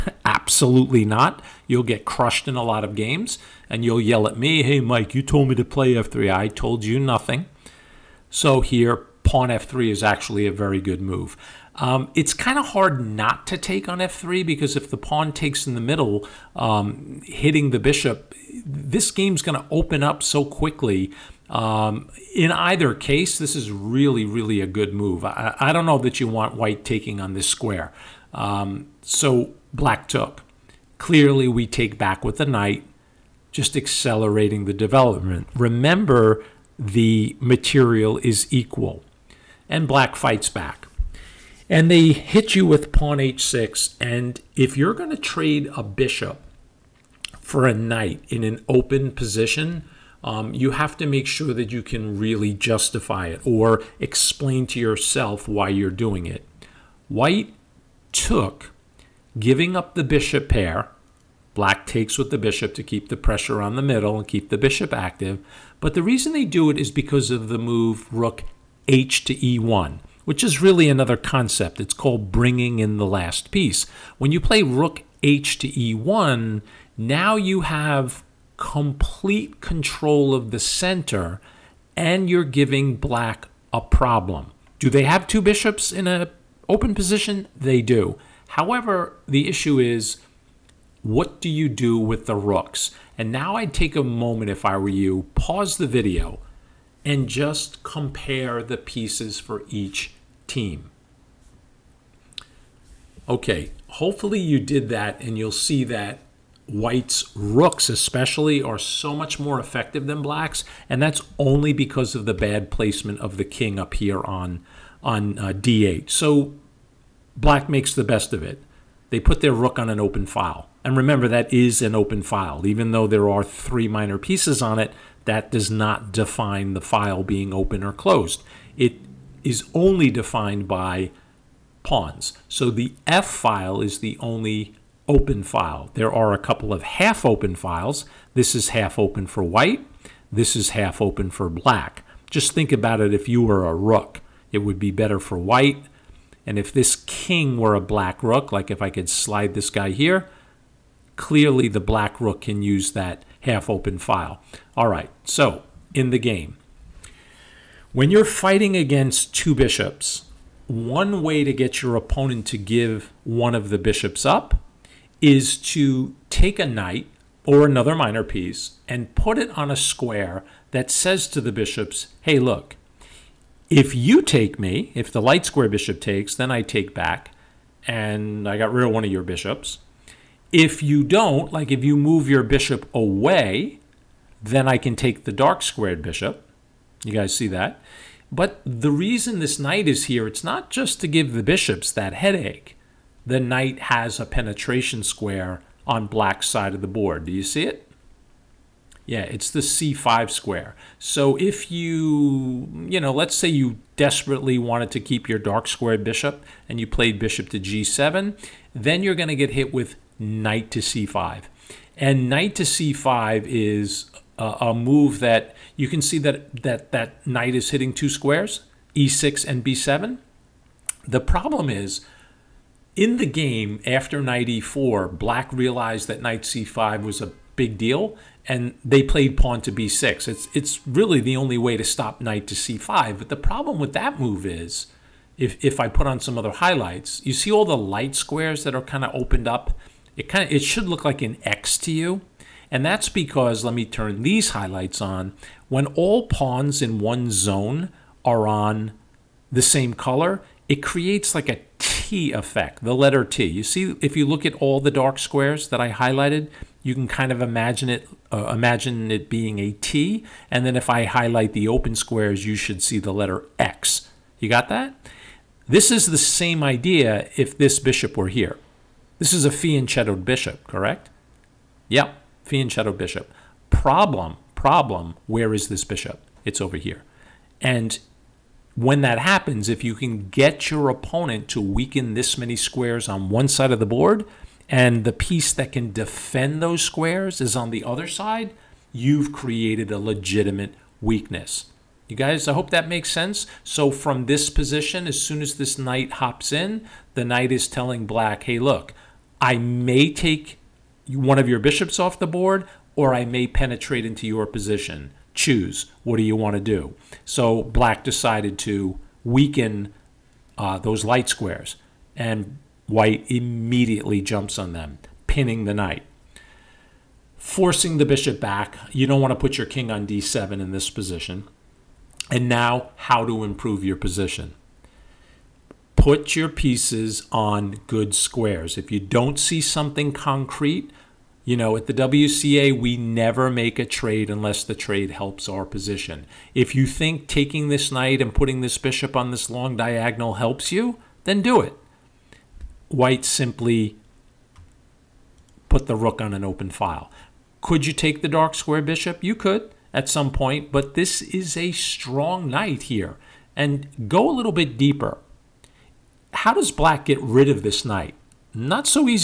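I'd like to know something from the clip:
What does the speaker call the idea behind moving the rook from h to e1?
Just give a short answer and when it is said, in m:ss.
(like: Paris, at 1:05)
Bringing in the last piece, at 1:12.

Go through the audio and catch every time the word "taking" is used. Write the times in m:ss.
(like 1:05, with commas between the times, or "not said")
0:26, 5:37.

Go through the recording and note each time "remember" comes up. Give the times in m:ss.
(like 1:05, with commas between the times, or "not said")
0:35, 2:00.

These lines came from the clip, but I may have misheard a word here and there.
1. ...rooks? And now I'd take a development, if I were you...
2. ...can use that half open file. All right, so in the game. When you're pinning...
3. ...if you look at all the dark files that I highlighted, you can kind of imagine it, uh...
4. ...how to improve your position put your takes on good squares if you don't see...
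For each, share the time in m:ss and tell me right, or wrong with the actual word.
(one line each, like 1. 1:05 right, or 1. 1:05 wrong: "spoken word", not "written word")
1. 1:32 wrong: "moment", not "development"
2. 2:32 wrong: "fighting", not "pinning"
3. 4:14 wrong: "squares", not "files"
4. 5:22 wrong: "pieces", not "takes".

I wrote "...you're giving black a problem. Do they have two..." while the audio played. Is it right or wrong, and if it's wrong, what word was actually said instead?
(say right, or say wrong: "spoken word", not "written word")
right.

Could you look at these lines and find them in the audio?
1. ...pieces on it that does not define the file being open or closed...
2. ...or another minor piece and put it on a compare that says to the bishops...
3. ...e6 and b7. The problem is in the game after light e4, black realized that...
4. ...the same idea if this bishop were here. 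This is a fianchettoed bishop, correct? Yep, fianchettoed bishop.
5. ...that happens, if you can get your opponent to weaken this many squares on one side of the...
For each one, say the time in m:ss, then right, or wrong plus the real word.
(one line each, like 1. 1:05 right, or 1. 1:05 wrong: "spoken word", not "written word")
1. 2:04 right
2. 2:47 wrong: "square", not "compare"
3. 3:38 wrong: "knight", not "light"
4. 4:26 right
5. 4:39 right.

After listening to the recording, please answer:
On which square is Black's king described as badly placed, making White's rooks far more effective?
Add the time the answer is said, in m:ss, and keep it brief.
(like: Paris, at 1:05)
d8, at 1:55.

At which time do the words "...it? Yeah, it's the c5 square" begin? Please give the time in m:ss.
3:17.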